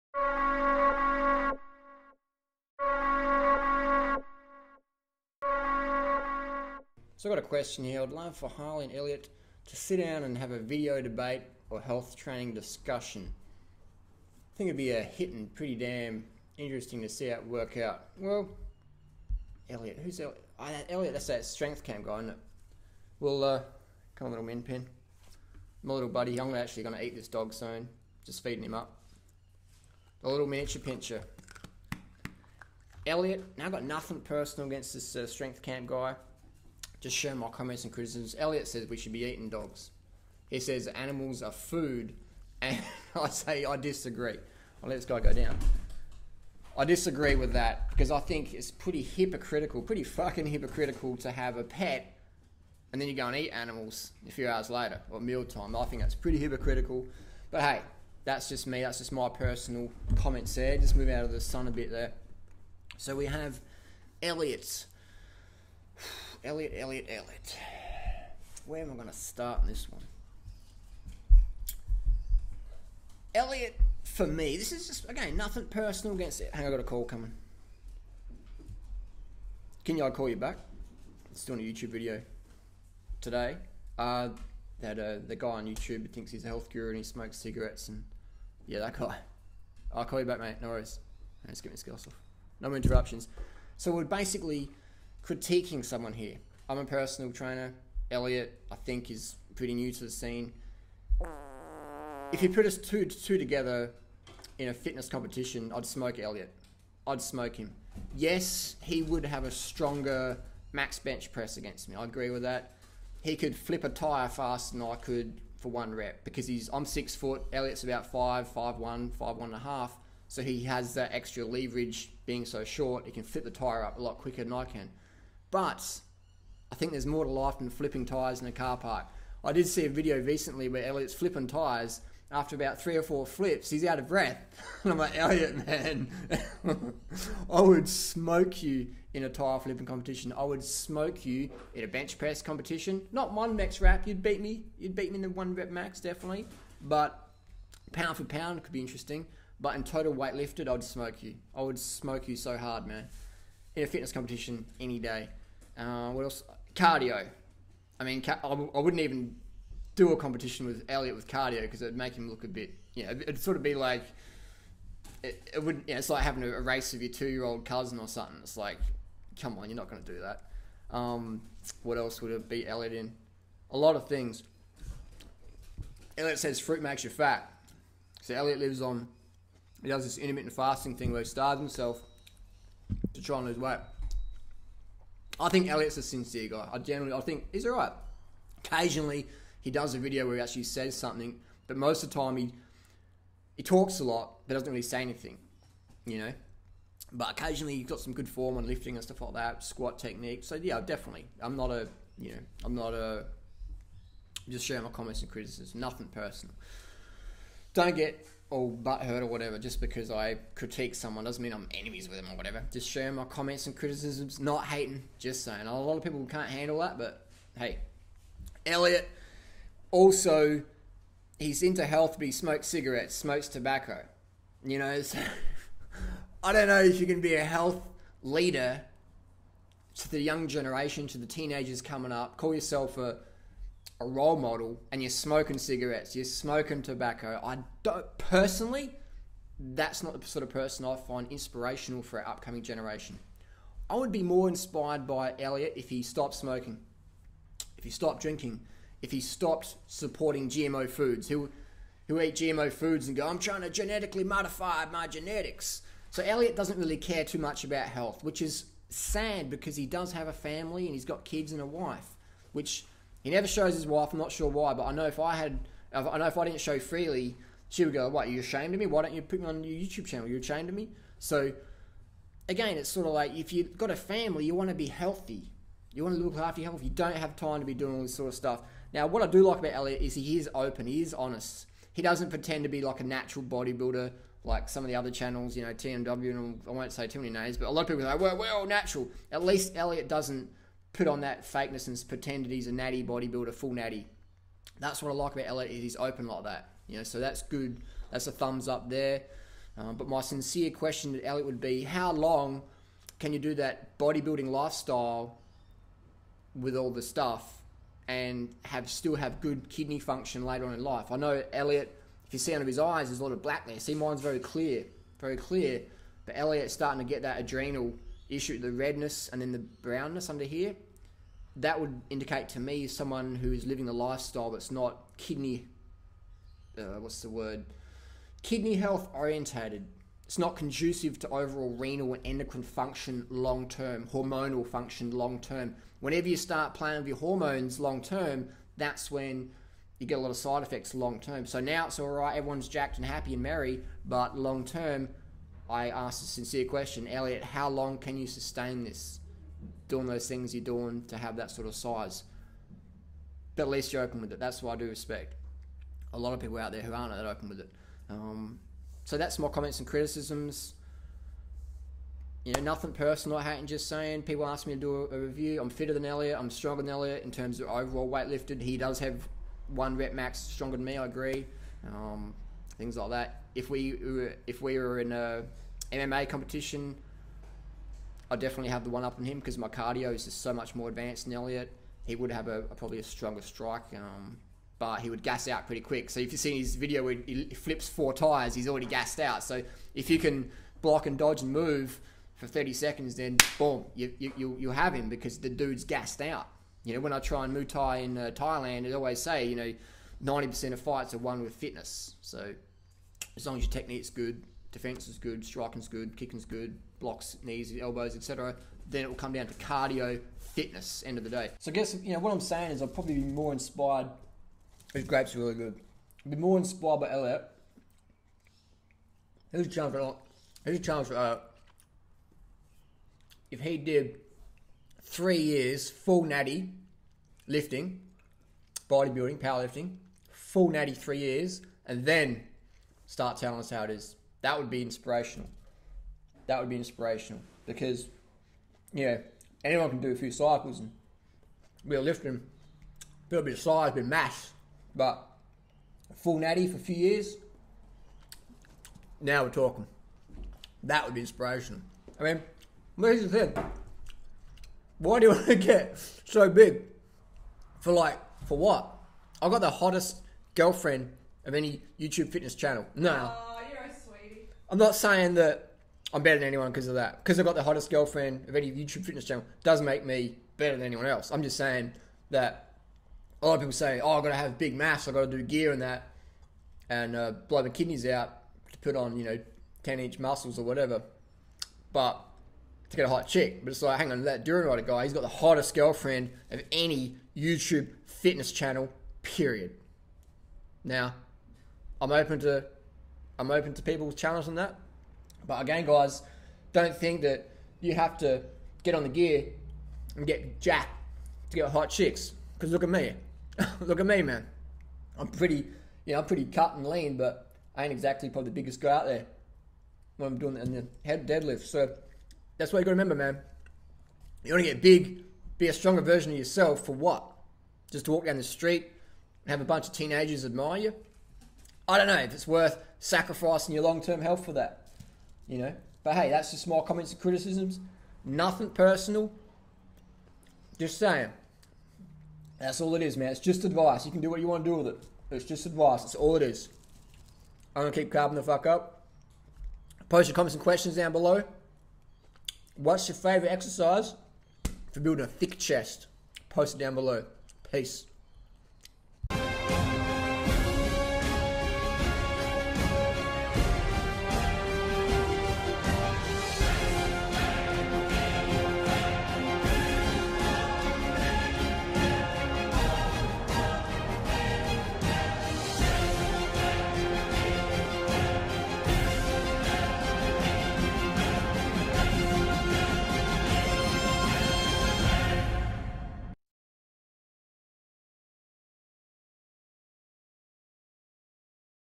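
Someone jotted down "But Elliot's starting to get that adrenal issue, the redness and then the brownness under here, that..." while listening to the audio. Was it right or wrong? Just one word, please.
right.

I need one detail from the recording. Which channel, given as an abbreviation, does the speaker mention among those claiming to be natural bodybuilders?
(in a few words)
TMW.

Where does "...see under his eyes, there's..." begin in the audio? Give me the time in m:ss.
5:12.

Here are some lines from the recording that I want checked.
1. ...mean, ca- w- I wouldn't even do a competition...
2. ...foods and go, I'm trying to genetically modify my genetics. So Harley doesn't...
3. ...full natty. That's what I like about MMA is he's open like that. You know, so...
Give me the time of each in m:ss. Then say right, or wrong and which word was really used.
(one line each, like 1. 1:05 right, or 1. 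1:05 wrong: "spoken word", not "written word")
1. 2:38 right
2. 4:12 wrong: "Elliot", not "Harley"
3. 4:53 wrong: "Elliot", not "MMA".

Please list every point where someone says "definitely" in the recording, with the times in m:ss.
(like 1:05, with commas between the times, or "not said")
2:25, 3:20, 6:18.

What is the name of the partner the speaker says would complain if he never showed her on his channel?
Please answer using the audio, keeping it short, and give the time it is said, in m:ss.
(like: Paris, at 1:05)
Freelee, at 4:26.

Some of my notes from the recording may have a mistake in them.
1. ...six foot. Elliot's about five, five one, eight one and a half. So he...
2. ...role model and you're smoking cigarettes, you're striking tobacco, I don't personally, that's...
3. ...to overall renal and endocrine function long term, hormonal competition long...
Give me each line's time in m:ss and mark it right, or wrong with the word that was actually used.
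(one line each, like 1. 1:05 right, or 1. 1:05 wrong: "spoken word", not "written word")
1. 1:56 wrong: "five", not "eight"
2. 3:54 wrong: "smoking", not "striking"
3. 5:31 wrong: "function", not "competition".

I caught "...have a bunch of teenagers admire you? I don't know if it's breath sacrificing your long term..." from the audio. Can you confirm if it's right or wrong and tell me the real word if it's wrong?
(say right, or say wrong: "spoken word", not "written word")
wrong: "worth", not "breath".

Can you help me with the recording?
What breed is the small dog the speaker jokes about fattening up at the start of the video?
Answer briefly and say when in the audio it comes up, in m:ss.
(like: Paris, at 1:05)
Miniature pinscher, at 0:30.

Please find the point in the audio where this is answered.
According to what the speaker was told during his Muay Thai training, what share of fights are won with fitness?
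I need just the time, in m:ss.
6:40.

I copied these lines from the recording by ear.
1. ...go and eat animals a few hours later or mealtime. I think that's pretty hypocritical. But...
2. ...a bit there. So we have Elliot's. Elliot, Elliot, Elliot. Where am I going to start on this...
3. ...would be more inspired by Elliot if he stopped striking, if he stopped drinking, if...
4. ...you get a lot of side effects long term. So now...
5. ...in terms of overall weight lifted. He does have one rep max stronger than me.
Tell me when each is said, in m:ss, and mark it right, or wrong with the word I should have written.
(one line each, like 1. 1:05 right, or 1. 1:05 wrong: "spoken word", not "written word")
1. 0:53 right
2. 1:01 right
3. 4:03 wrong: "smoking", not "striking"
4. 5:39 right
5. 6:07 right.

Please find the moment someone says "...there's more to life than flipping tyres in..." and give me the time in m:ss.
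2:06.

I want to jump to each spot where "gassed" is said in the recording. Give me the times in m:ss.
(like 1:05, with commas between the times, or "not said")
6:28, 6:35.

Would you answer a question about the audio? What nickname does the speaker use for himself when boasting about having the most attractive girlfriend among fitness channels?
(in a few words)
Durianrider.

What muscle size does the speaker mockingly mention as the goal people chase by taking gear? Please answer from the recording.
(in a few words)
10 inch.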